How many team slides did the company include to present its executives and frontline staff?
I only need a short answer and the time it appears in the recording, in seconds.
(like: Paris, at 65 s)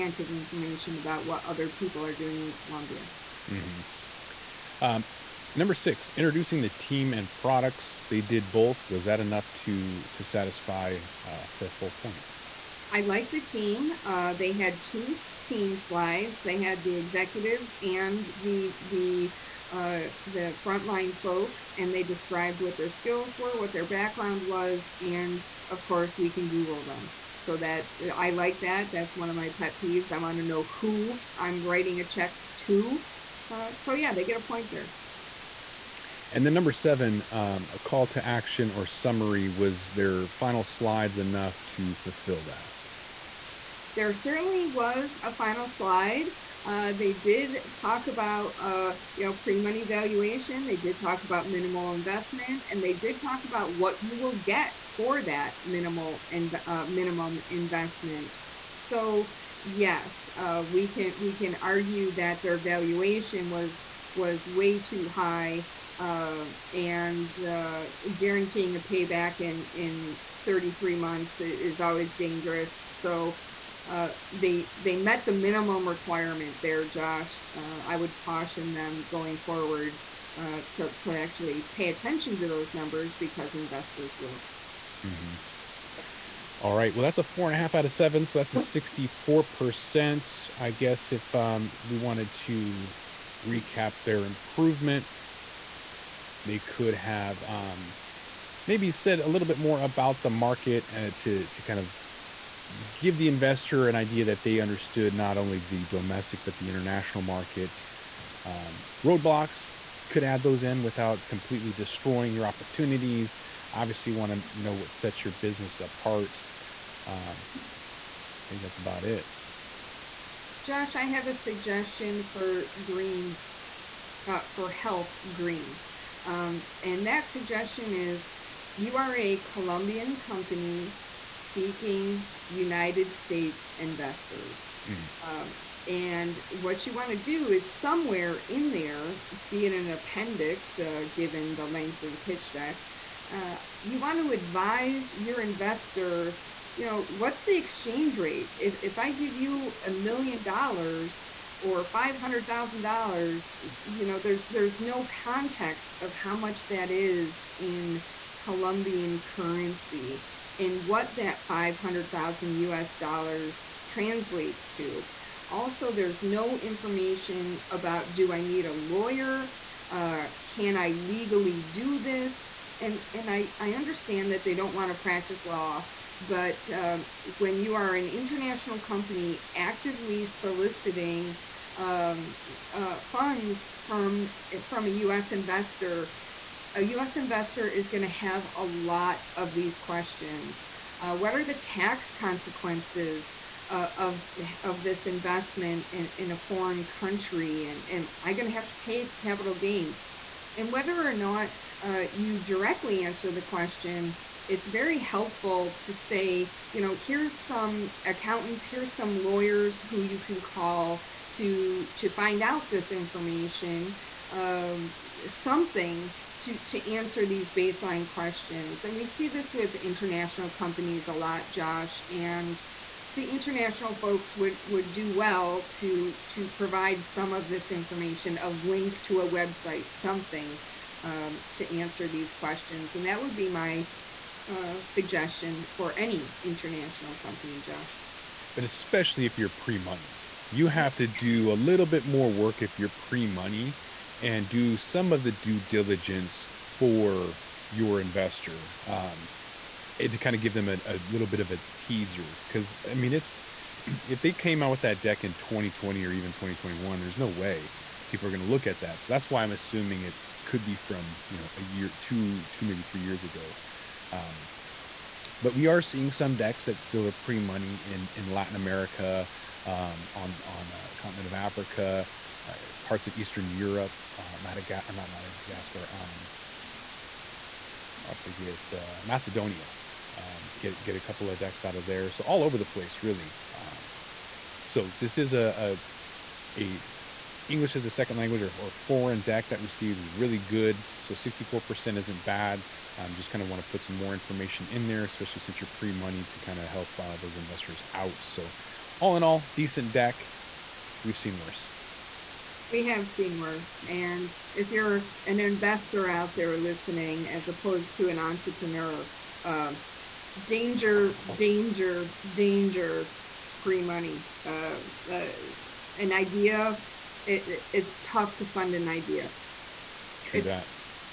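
2, at 14 s.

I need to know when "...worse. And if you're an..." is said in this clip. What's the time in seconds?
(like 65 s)
303 s.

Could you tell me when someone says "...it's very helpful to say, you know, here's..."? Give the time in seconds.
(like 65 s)
204 s.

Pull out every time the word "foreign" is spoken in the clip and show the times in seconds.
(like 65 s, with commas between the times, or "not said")
196 s, 288 s.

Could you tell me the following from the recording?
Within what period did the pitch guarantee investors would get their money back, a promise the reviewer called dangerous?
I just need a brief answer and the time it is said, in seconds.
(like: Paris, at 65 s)
33 months, at 70 s.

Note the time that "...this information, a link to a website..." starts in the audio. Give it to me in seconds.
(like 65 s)
227 s.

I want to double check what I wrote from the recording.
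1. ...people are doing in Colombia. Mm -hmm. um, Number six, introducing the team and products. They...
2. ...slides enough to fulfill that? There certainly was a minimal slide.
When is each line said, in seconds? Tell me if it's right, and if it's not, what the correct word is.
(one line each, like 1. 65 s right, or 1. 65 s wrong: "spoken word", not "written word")
1. 1 s right
2. 40 s wrong: "final", not "minimal".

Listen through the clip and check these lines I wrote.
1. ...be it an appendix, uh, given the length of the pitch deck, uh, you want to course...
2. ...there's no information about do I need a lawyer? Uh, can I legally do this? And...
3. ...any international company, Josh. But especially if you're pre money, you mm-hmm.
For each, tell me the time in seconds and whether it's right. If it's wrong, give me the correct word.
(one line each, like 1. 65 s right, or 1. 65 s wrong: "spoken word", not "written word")
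1. 139 s wrong: "advise", not "course"
2. 165 s right
3. 235 s right.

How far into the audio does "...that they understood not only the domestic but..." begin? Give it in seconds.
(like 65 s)
104 s.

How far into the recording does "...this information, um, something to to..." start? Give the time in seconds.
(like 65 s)
212 s.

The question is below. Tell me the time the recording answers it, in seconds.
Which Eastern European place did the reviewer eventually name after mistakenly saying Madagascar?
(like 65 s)
279 s.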